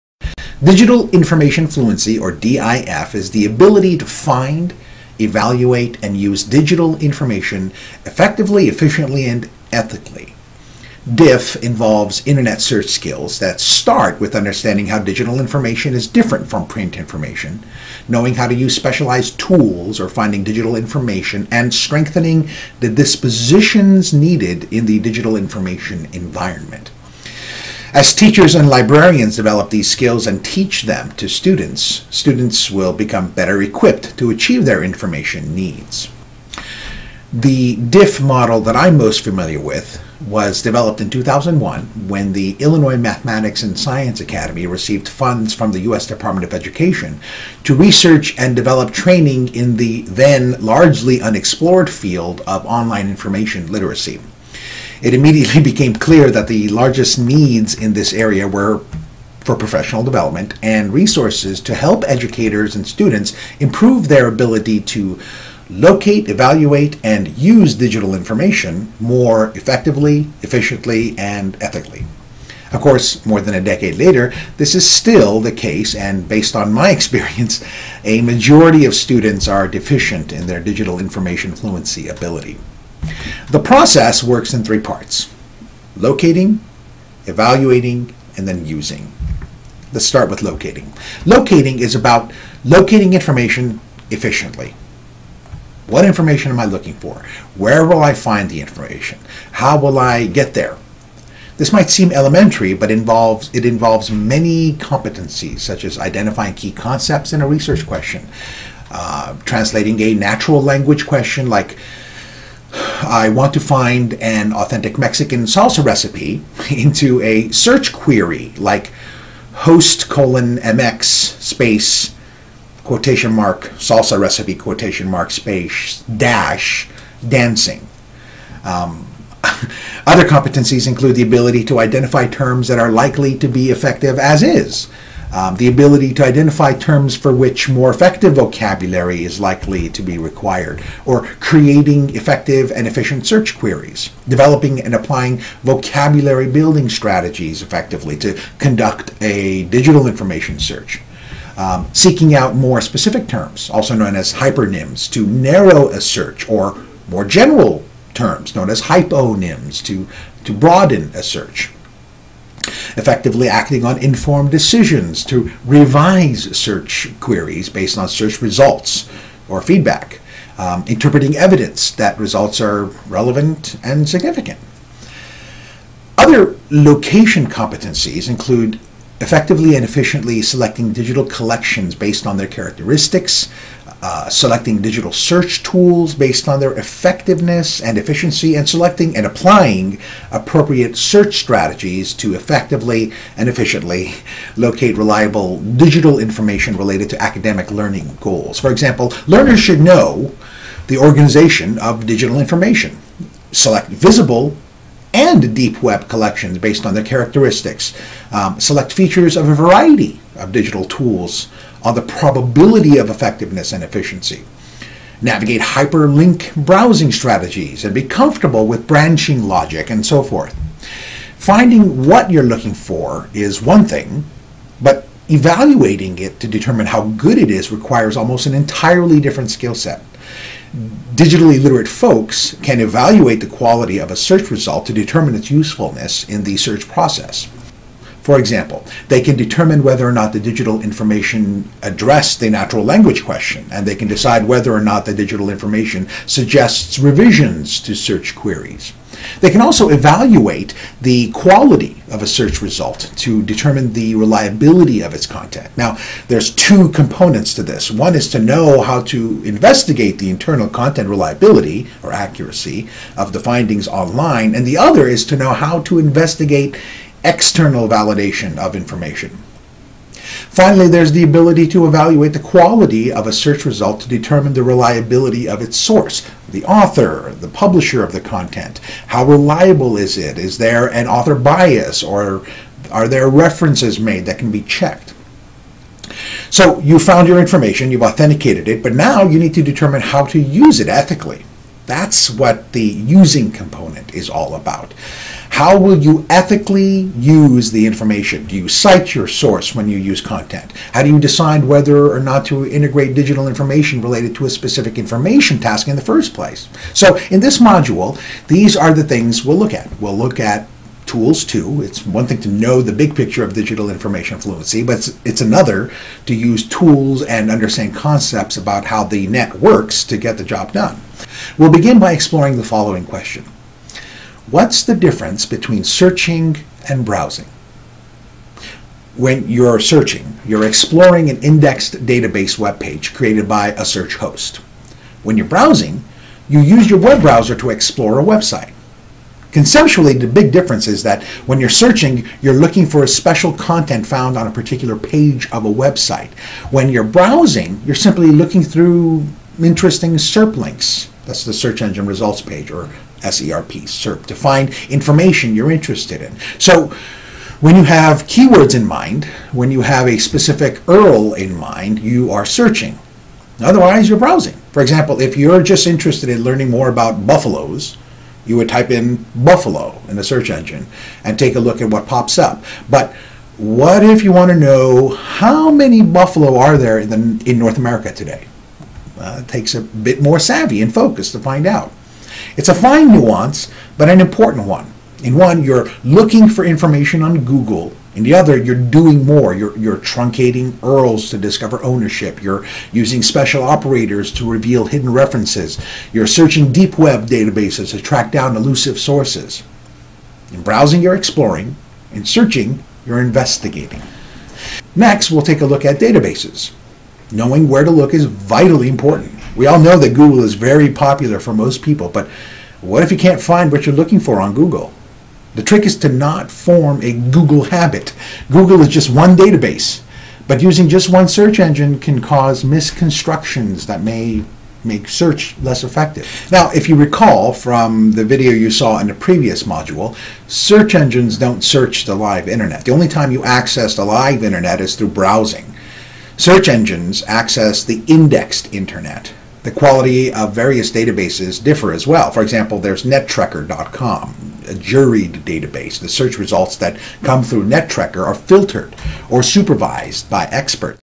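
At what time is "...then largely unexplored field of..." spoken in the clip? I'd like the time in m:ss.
0:50.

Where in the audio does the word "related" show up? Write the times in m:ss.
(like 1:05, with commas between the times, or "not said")
3:16, 5:04.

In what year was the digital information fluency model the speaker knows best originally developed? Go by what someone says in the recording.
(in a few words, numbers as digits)
2001.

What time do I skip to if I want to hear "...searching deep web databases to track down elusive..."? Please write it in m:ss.
6:36.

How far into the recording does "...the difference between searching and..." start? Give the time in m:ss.
5:24.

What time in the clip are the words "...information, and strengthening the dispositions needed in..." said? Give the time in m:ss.
0:20.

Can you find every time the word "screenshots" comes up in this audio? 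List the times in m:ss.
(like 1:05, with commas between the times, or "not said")
not said.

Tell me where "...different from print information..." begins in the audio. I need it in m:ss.
0:16.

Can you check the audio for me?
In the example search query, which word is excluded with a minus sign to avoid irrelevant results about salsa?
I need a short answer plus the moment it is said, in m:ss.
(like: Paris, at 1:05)
dancing, at 2:07.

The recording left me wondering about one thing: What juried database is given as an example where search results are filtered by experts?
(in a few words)
NetTrekker.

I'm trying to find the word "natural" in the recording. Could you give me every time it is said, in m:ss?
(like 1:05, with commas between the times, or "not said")
1:50, 4:02.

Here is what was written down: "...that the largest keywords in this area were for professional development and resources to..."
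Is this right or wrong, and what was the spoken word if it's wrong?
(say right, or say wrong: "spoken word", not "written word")
wrong: "needs", not "keywords".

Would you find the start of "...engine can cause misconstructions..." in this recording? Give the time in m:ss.
7:01.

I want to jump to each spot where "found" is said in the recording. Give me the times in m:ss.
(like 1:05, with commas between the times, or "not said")
4:46, 5:44.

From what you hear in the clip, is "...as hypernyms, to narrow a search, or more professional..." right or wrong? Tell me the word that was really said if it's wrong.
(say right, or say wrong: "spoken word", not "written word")
wrong: "general", not "professional".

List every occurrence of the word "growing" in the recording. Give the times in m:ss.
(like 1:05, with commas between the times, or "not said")
not said.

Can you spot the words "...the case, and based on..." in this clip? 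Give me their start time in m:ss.
1:15.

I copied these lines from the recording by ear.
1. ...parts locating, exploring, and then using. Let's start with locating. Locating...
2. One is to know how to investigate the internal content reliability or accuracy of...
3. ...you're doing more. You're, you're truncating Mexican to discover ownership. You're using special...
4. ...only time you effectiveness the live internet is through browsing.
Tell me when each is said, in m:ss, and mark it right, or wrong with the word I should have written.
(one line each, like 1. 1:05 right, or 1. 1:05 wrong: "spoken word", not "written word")
1. 1:24 wrong: "evaluating", not "exploring"
2. 4:17 right
3. 6:28 wrong: "URLs", not "Mexican"
4. 7:12 wrong: "access", not "effectiveness".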